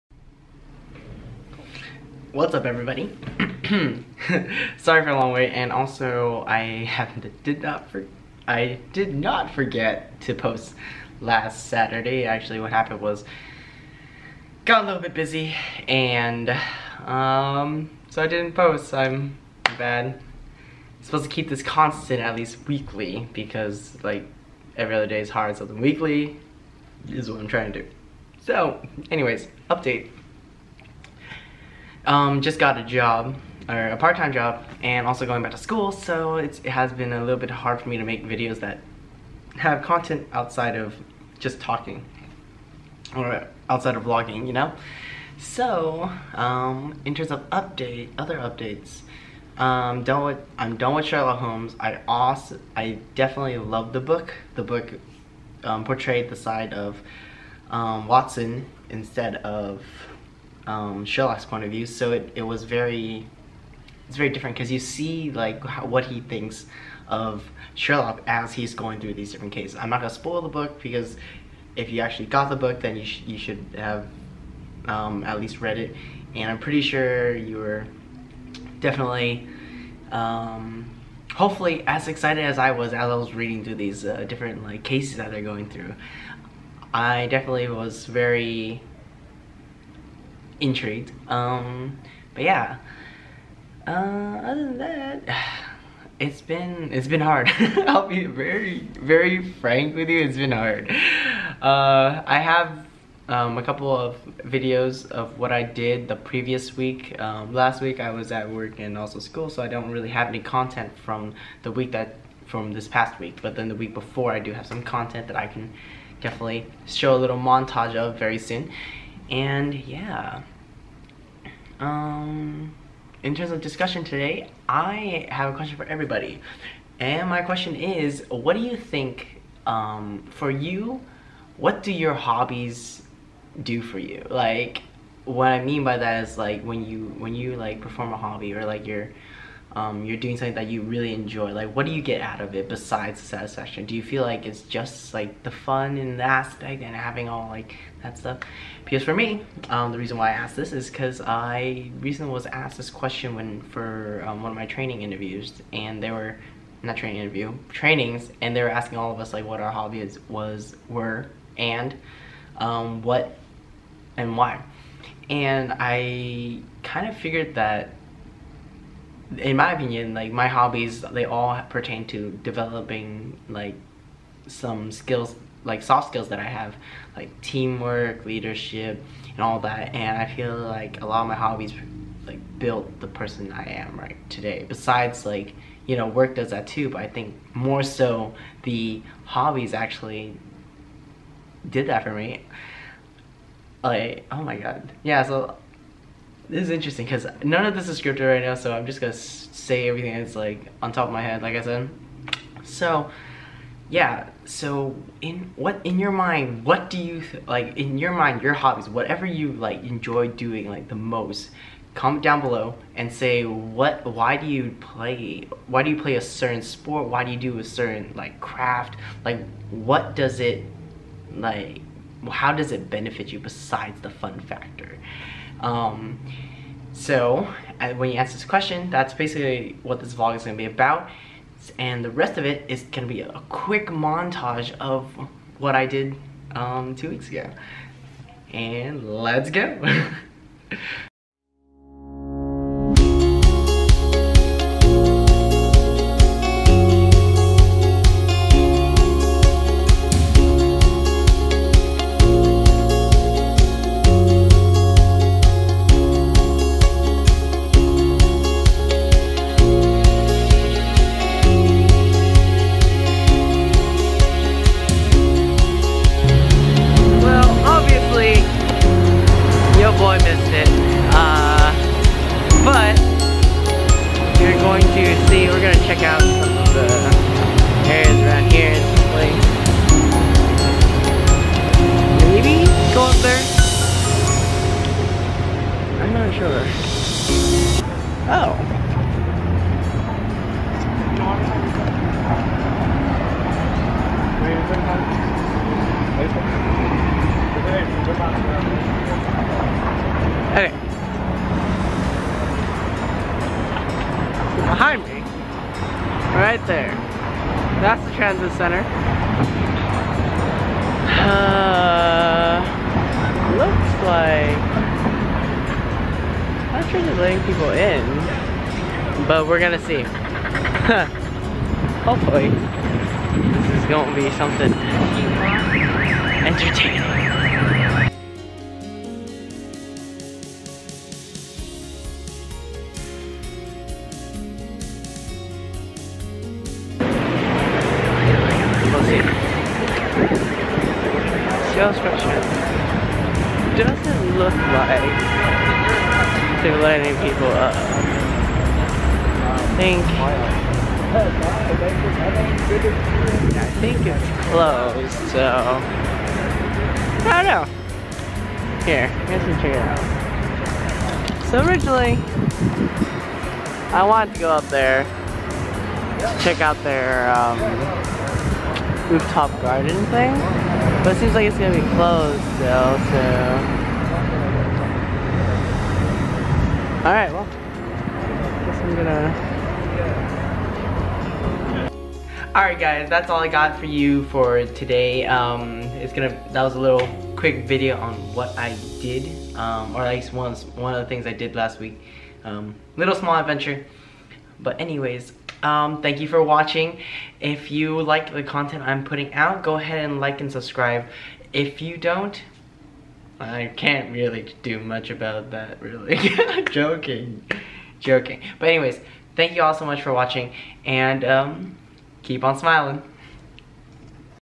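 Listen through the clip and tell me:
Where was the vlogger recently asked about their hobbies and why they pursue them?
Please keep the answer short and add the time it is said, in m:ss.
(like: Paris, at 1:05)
trainings, at 2:37.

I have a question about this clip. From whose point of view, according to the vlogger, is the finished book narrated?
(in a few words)
Watson.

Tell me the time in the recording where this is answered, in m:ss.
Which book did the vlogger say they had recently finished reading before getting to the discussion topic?
0:51.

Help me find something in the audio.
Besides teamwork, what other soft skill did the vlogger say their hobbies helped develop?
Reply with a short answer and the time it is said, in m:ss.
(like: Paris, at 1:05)
leadership, at 2:58.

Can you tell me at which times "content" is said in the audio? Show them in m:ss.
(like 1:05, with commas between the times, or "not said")
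0:39, 1:50, 1:54, 6:38.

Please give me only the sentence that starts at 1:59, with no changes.
And yeah um, in terms of discussion today, I have a question for everybody.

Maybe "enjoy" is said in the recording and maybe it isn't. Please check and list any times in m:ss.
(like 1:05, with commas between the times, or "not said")
2:21, 3:29.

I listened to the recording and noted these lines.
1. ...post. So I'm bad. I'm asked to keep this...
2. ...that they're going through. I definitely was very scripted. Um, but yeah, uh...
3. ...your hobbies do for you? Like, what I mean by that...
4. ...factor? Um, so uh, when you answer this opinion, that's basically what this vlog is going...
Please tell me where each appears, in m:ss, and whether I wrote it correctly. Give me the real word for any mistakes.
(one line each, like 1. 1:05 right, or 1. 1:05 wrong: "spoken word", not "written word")
1. 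0:18 wrong: "supposed", not "asked"
2. 1:25 wrong: "intrigued", not "scripted"
3. 2:11 right
4. 3:44 wrong: "question", not "opinion".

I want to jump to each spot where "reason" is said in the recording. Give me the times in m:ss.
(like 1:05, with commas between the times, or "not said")
2:29.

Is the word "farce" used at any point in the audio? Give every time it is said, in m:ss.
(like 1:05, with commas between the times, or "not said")
not said.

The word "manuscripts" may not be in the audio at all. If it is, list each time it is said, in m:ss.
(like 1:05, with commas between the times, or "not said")
not said.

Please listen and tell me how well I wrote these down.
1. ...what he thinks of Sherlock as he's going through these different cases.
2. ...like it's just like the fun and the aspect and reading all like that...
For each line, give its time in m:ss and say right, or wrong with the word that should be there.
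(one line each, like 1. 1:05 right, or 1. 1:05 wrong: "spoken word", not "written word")
1. 1:05 right
2. 2:24 wrong: "having", not "reading".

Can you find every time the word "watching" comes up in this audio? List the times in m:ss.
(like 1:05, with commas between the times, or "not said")
6:36, 6:50.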